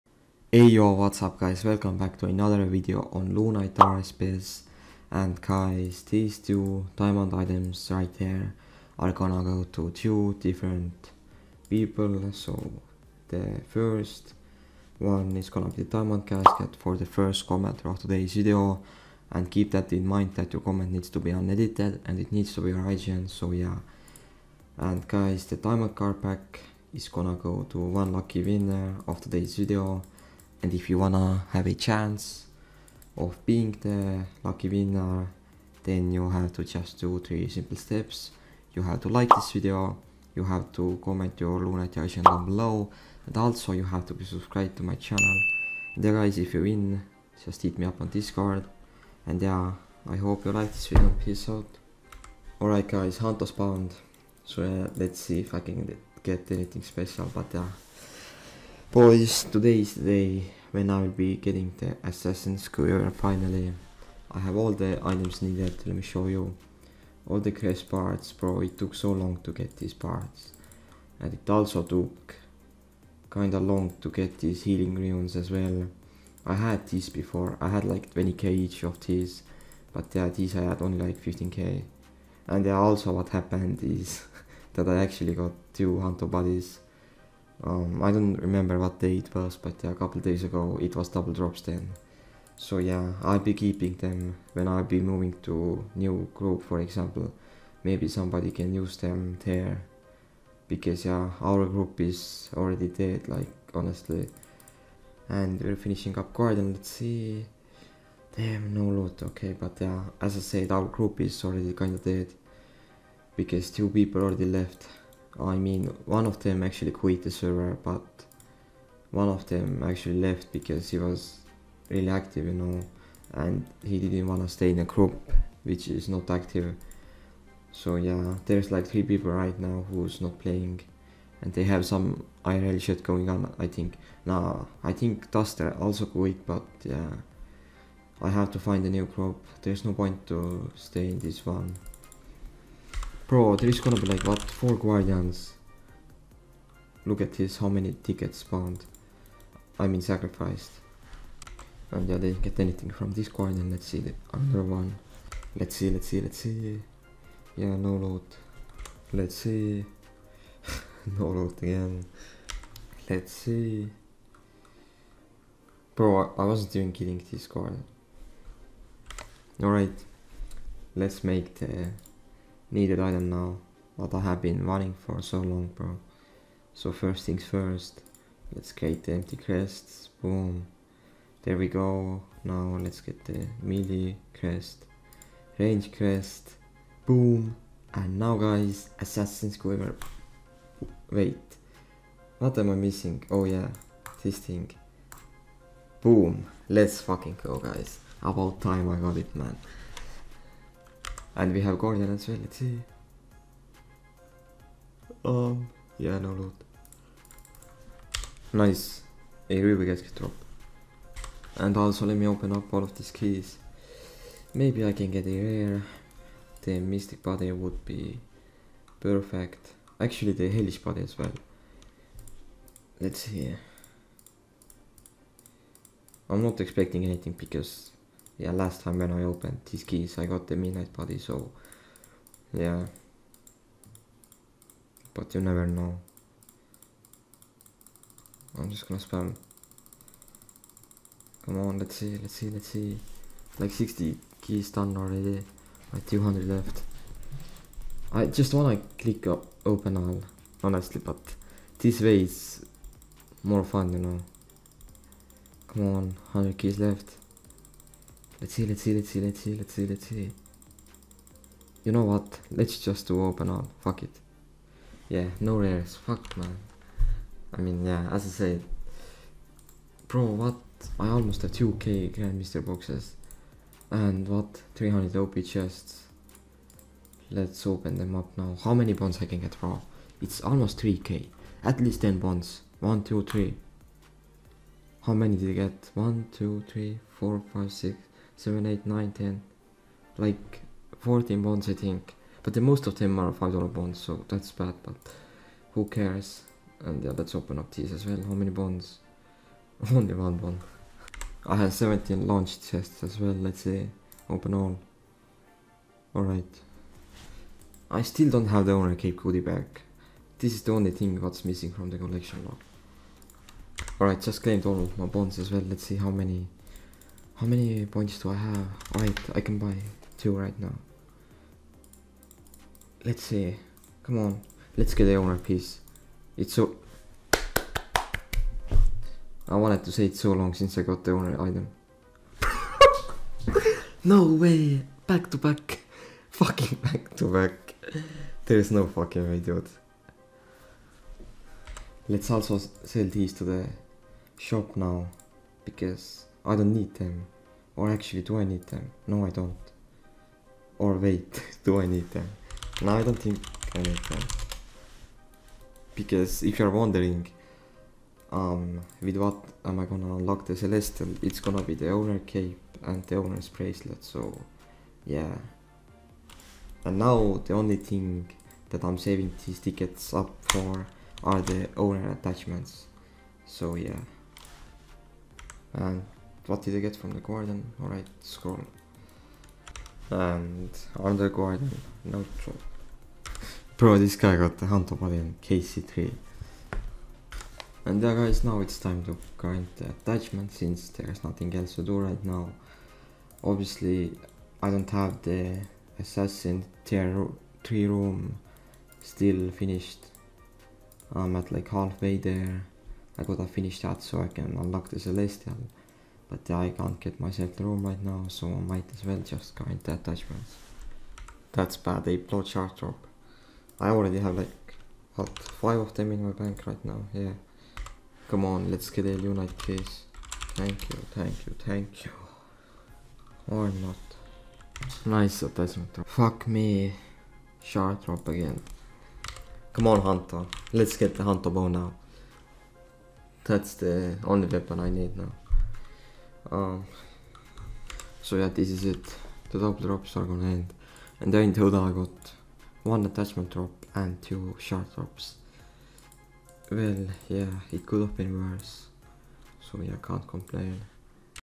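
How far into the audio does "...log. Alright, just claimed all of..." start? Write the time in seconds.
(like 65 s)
312 s.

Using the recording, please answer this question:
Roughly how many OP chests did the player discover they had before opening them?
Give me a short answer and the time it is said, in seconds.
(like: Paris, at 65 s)
300, at 274 s.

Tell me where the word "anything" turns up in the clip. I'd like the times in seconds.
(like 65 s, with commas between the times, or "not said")
56 s, 152 s, 227 s.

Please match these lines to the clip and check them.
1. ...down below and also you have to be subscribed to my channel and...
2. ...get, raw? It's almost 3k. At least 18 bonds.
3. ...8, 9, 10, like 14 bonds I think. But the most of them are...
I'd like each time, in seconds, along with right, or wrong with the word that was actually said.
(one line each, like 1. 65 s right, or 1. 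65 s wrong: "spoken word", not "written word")
1. 42 s right
2. 279 s wrong: "10", not "18"
3. 288 s right.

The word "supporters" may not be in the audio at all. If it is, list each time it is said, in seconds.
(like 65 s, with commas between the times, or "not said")
not said.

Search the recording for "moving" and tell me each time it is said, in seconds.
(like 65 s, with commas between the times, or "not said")
94 s.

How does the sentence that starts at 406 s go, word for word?
But I can't get myself the room right now, so I might as well just grind the attachments.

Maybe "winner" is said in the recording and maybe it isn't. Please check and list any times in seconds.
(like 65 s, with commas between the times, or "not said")
28 s, 34 s.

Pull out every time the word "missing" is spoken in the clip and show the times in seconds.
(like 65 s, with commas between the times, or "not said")
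192 s, 311 s.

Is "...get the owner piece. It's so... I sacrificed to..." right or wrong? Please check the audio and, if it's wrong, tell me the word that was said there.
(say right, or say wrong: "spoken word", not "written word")
wrong: "wanted", not "sacrificed".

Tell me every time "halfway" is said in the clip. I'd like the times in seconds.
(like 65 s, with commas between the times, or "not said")
401 s.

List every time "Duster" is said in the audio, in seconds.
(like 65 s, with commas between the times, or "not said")
135 s.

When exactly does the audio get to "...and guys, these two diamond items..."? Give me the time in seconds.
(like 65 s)
5 s.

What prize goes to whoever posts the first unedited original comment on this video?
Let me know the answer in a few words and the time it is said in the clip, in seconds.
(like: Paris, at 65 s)
Diamond casket, at 15 s.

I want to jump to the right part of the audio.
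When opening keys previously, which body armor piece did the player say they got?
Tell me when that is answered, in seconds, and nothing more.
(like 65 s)
230 s.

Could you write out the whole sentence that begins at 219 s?
Actually, the Hellish Body as well.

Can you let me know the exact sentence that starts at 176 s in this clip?
So first things first, let's get the empty crests, boom.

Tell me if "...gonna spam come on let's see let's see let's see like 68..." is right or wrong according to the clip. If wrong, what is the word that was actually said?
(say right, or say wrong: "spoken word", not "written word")
wrong: "60", not "68".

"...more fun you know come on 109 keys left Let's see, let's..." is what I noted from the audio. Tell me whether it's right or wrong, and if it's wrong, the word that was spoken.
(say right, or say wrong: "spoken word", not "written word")
wrong: "100", not "109".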